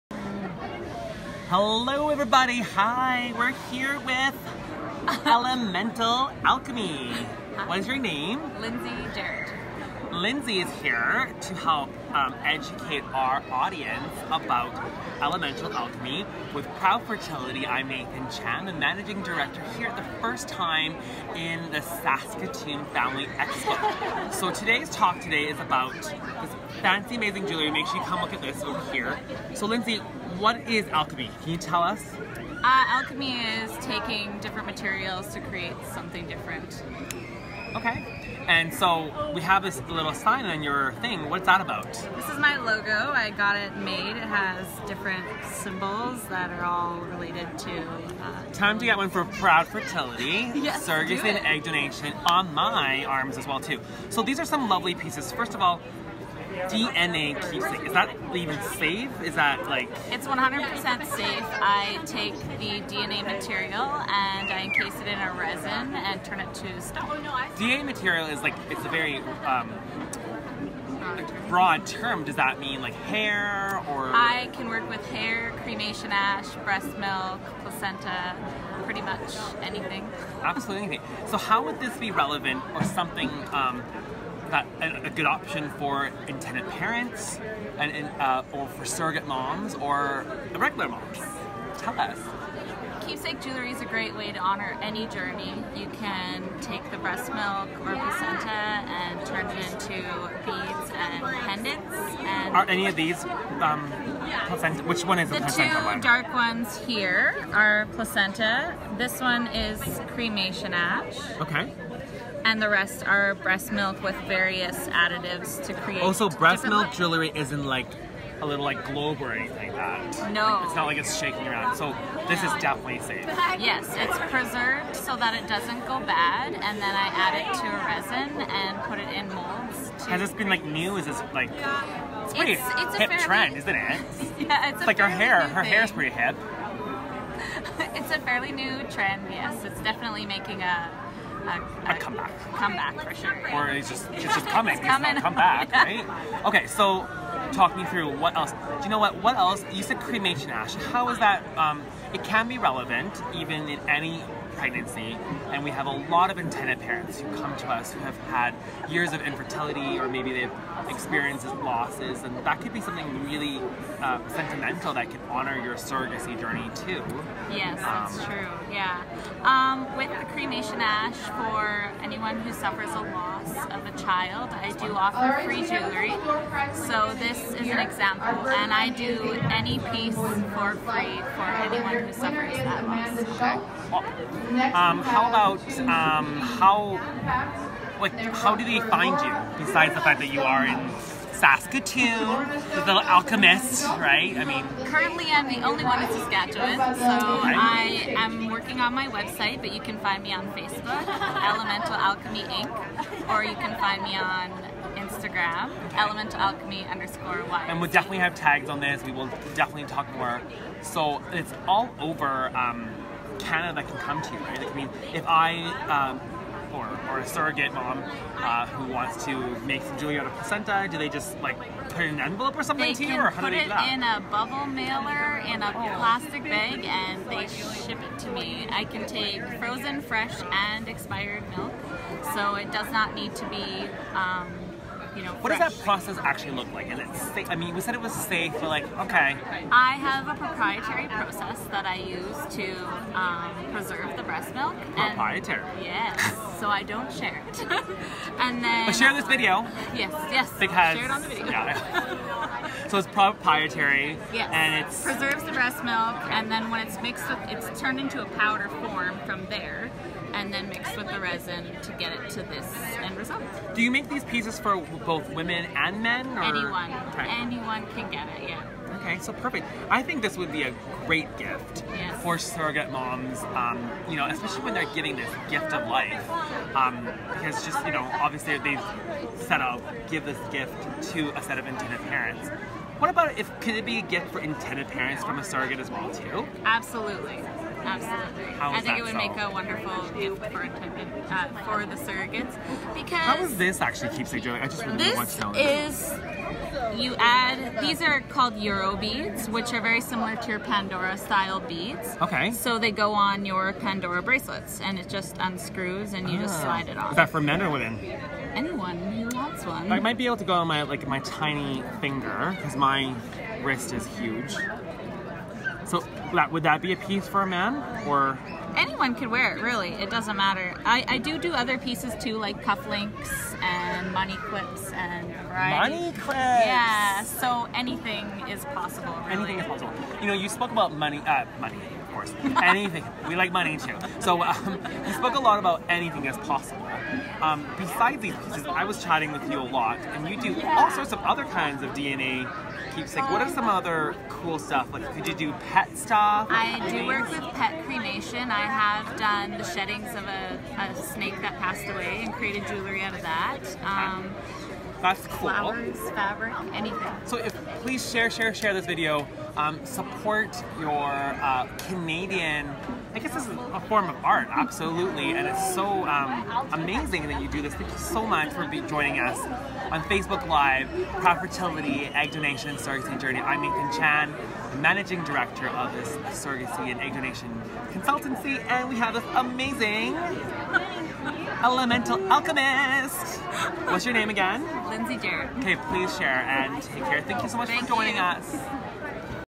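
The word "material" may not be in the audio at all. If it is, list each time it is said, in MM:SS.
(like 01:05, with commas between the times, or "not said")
00:34, 01:03, 01:07.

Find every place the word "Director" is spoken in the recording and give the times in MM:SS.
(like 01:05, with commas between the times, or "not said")
00:19, 06:15.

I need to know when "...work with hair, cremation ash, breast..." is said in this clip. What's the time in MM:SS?
01:14.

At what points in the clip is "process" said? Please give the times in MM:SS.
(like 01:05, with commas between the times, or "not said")
03:55, 04:01.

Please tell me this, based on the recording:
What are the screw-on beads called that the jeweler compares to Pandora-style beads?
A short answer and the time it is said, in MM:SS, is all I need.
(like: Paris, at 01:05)
Euro beads, at 04:58.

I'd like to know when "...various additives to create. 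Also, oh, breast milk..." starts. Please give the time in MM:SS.
01:54.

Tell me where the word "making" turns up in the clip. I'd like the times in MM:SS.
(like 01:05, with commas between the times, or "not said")
02:20.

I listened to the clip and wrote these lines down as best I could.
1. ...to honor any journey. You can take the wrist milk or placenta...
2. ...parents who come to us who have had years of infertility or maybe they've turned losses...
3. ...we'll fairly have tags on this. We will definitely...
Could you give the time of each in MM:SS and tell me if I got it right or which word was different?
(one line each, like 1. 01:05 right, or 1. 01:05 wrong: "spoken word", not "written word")
1. 01:34 wrong: "breast", not "wrist"
2. 02:36 wrong: "experienced", not "turned"
3. 03:27 wrong: "definitely", not "fairly".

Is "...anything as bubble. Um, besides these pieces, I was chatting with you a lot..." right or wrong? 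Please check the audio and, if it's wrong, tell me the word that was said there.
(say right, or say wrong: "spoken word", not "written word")
wrong: "possible", not "bubble".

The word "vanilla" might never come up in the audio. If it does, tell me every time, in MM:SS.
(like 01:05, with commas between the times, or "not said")
not said.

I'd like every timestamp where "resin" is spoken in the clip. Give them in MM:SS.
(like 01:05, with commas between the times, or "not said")
01:05, 02:07, 04:21.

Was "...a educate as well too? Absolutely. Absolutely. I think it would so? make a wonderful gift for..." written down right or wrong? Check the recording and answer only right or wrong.
wrong.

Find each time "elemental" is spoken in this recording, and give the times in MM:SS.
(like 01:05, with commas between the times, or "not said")
00:05, 00:15, 03:21, 03:25, 06:21.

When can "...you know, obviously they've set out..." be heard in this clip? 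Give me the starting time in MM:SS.
04:37.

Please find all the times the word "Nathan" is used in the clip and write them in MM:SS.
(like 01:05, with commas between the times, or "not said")
00:17, 06:13.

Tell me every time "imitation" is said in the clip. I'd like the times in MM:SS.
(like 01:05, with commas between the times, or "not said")
not said.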